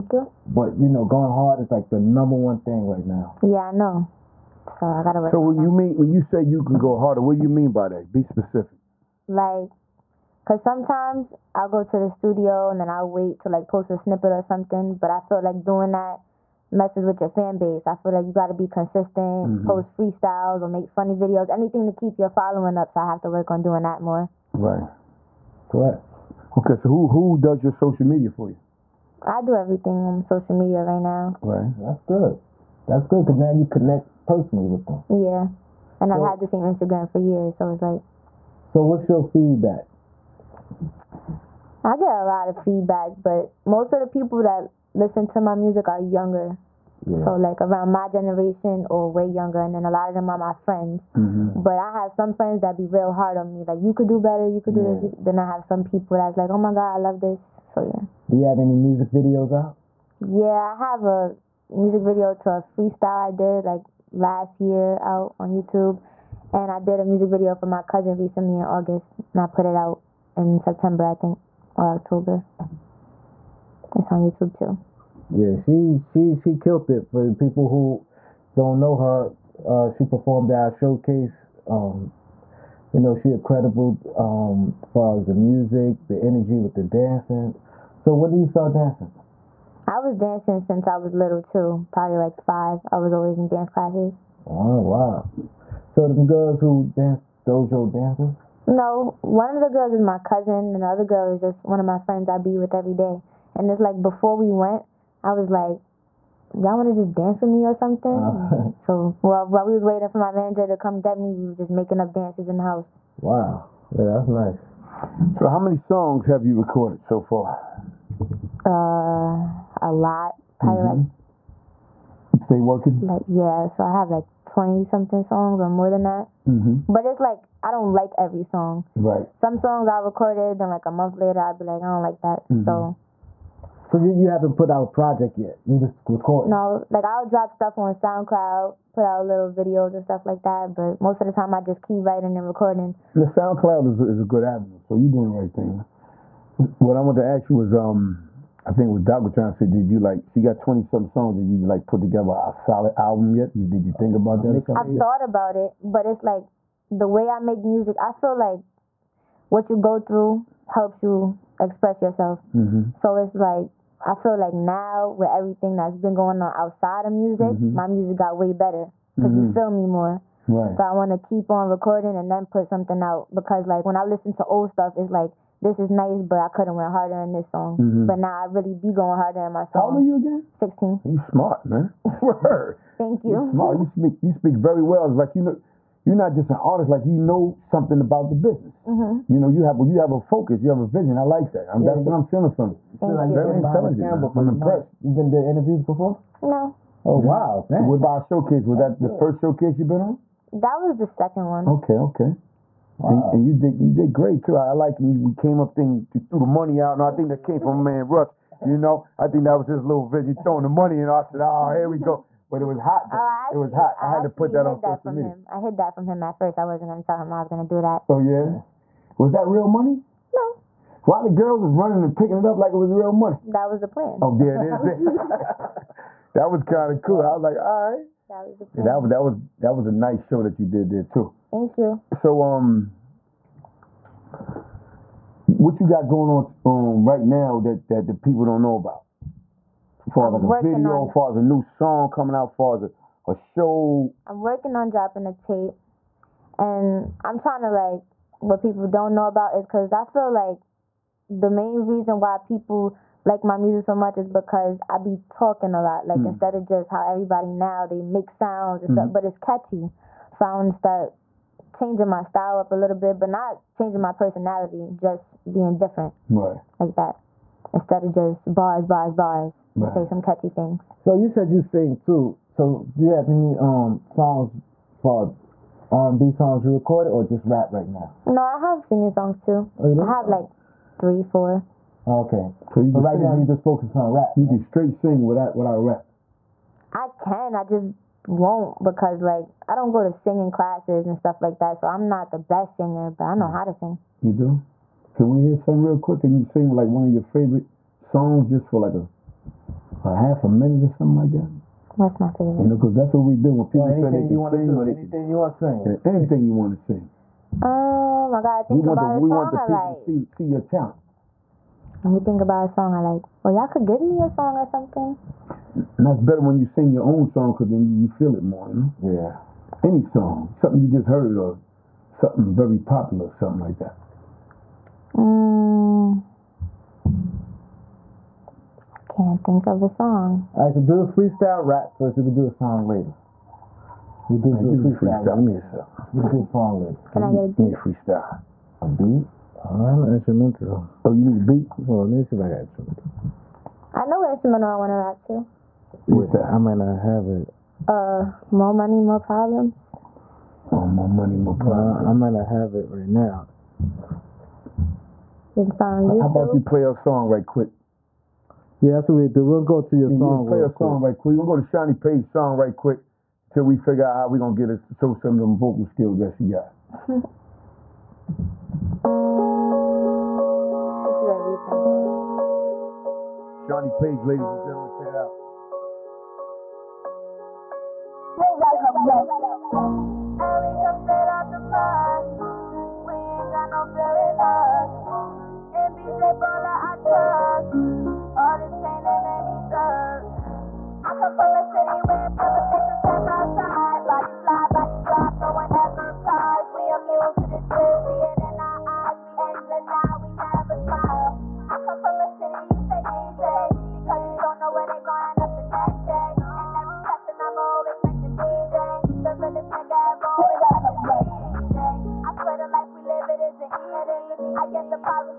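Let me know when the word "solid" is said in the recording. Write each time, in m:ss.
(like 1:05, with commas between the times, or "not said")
2:32.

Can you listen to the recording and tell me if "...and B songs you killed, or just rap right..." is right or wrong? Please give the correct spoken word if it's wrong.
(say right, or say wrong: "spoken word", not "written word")
wrong: "recorded", not "killed".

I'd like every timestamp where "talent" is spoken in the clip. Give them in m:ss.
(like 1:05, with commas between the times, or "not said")
5:10.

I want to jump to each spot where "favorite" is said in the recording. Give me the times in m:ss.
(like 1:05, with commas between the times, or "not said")
4:57, 5:02.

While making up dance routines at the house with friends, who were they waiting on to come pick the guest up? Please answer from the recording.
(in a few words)
Manager.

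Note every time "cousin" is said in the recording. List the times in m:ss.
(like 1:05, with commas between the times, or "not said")
1:07, 1:40.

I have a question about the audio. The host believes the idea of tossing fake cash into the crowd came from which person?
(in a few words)
Russ.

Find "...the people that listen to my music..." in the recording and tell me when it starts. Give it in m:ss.
0:44.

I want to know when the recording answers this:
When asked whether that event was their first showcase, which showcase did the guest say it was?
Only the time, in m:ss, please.
3:20.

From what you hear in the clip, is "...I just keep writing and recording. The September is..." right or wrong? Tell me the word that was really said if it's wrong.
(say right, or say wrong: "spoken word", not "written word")
wrong: "SoundCloud", not "September".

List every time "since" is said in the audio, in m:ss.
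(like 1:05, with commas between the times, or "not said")
1:30.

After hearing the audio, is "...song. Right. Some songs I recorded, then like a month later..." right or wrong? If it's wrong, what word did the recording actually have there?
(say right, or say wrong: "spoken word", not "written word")
right.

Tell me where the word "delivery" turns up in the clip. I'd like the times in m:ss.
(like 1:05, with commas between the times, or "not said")
not said.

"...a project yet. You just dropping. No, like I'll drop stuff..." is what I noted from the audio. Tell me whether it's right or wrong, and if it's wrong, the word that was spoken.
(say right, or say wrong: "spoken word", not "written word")
wrong: "recording", not "dropping".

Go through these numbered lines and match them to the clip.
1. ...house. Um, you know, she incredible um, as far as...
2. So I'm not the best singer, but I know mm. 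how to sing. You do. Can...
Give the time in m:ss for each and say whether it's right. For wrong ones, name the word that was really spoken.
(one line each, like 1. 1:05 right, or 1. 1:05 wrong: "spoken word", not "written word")
1. 1:20 wrong: "showcase", not "house"
2. 4:51 right.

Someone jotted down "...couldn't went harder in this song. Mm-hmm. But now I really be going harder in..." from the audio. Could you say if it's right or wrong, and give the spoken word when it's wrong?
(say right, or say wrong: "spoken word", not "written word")
right.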